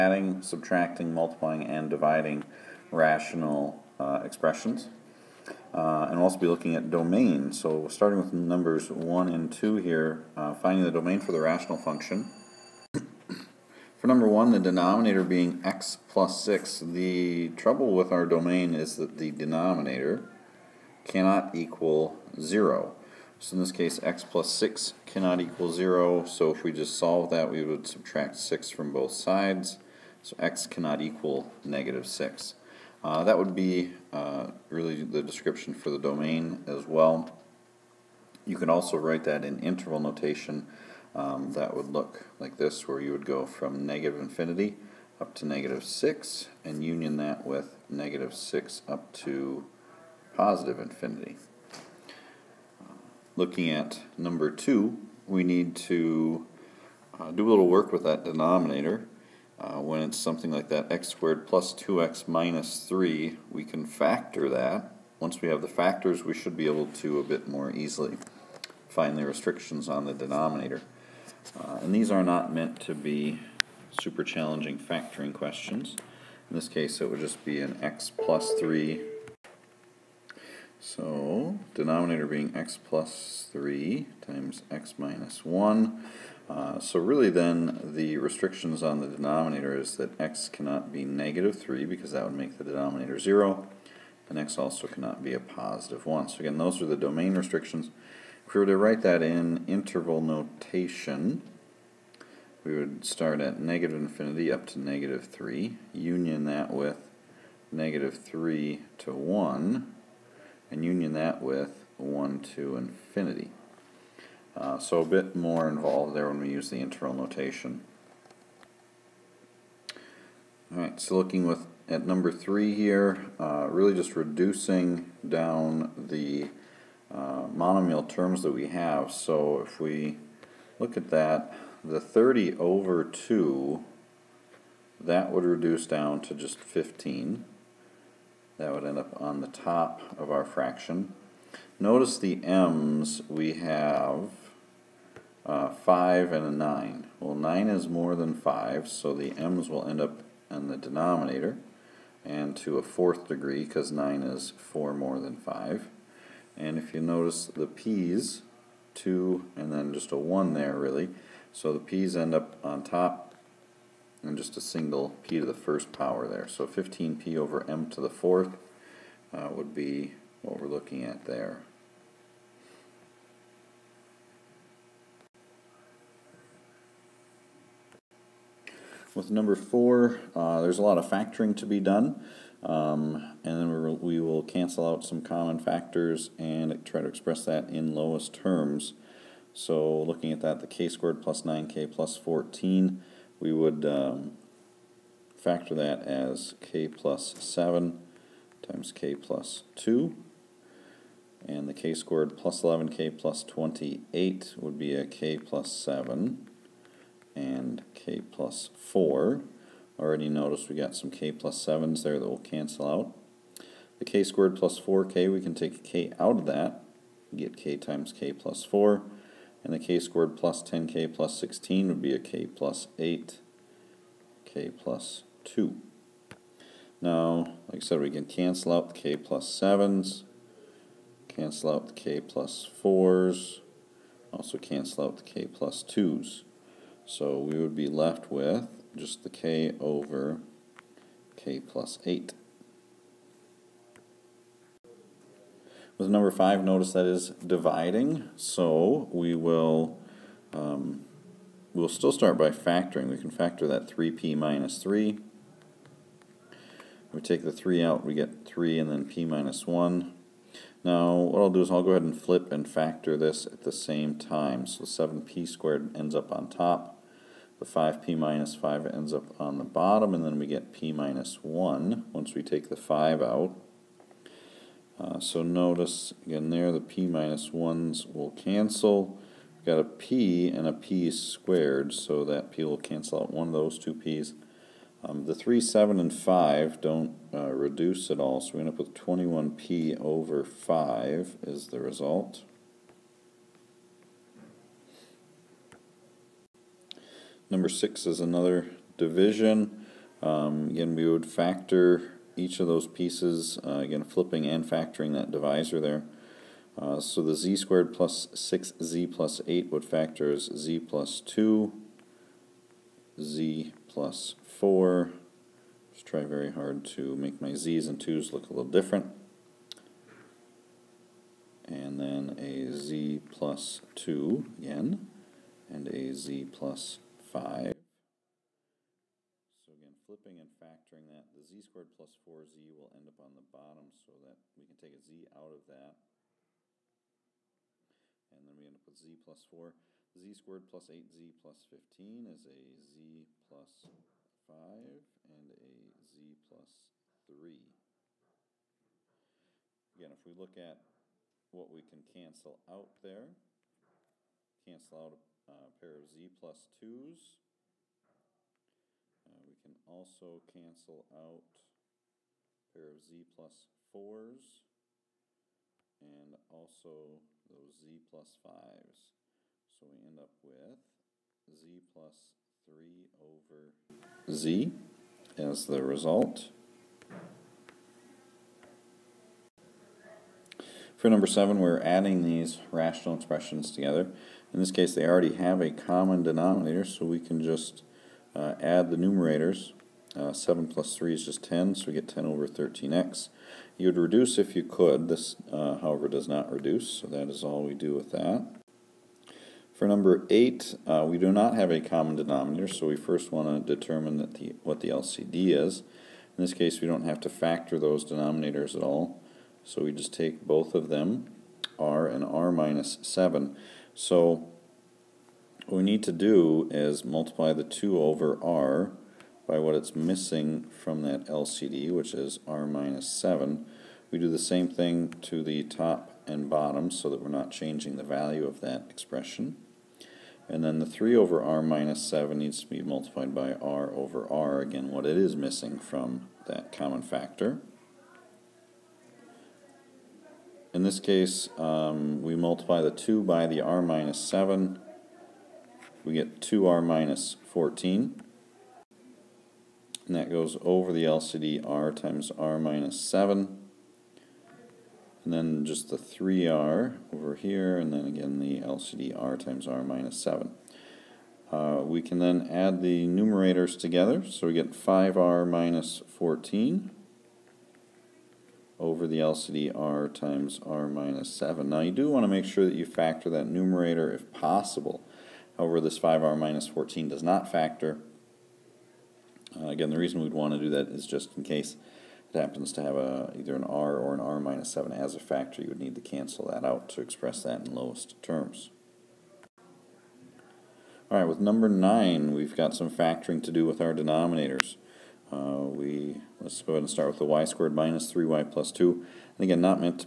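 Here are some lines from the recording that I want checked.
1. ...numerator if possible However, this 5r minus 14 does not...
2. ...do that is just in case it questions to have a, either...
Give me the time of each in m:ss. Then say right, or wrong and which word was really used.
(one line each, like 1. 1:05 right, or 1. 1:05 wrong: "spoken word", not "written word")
1. 7:53 right
2. 8:00 wrong: "happens", not "questions".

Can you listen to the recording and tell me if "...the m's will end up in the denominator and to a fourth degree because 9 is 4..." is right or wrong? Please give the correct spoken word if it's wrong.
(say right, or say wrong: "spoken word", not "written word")
right.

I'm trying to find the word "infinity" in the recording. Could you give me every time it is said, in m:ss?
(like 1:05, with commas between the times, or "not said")
0:44, 0:50, 1:43, 1:52.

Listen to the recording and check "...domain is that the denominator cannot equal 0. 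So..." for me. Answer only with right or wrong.
right.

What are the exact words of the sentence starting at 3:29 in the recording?
Already noticed we got some k plus 7s there that will cancel out.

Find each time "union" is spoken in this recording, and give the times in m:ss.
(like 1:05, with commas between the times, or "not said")
0:46, 1:45, 1:50.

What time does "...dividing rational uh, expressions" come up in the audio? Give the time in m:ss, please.
0:01.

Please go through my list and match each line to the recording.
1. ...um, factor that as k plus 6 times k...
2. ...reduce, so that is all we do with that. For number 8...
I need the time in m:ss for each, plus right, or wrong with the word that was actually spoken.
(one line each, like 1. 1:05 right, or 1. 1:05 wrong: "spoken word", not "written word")
1. 3:13 wrong: "7", not "6"
2. 6:36 right.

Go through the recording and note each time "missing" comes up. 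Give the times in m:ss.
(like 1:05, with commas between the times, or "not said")
6:59, 7:15.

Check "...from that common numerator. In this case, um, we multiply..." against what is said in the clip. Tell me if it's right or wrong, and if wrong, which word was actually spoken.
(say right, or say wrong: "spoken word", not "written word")
wrong: "factor", not "numerator".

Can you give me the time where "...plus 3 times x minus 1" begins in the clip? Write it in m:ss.
1:22.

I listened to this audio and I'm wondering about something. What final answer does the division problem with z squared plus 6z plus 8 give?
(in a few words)
z+3 over z.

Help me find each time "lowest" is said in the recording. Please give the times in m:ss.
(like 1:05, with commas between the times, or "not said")
3:07, 8:07.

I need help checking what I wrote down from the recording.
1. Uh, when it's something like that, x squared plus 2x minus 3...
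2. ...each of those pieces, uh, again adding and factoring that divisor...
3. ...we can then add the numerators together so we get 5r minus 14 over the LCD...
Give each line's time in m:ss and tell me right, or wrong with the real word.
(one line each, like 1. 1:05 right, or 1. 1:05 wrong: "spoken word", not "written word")
1. 0:59 right
2. 5:02 wrong: "flipping", not "adding"
3. 7:41 right.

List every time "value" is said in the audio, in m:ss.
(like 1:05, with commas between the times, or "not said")
7:08.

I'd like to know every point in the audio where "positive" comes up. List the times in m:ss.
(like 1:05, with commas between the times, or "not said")
0:50, 1:35.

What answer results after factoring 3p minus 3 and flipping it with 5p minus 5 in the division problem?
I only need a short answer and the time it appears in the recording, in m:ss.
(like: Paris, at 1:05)
21p over 5, at 4:48.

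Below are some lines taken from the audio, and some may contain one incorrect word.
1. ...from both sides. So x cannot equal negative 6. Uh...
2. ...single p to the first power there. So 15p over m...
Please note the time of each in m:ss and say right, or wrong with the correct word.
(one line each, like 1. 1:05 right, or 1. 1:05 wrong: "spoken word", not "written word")
1. 0:28 right
2. 2:44 right.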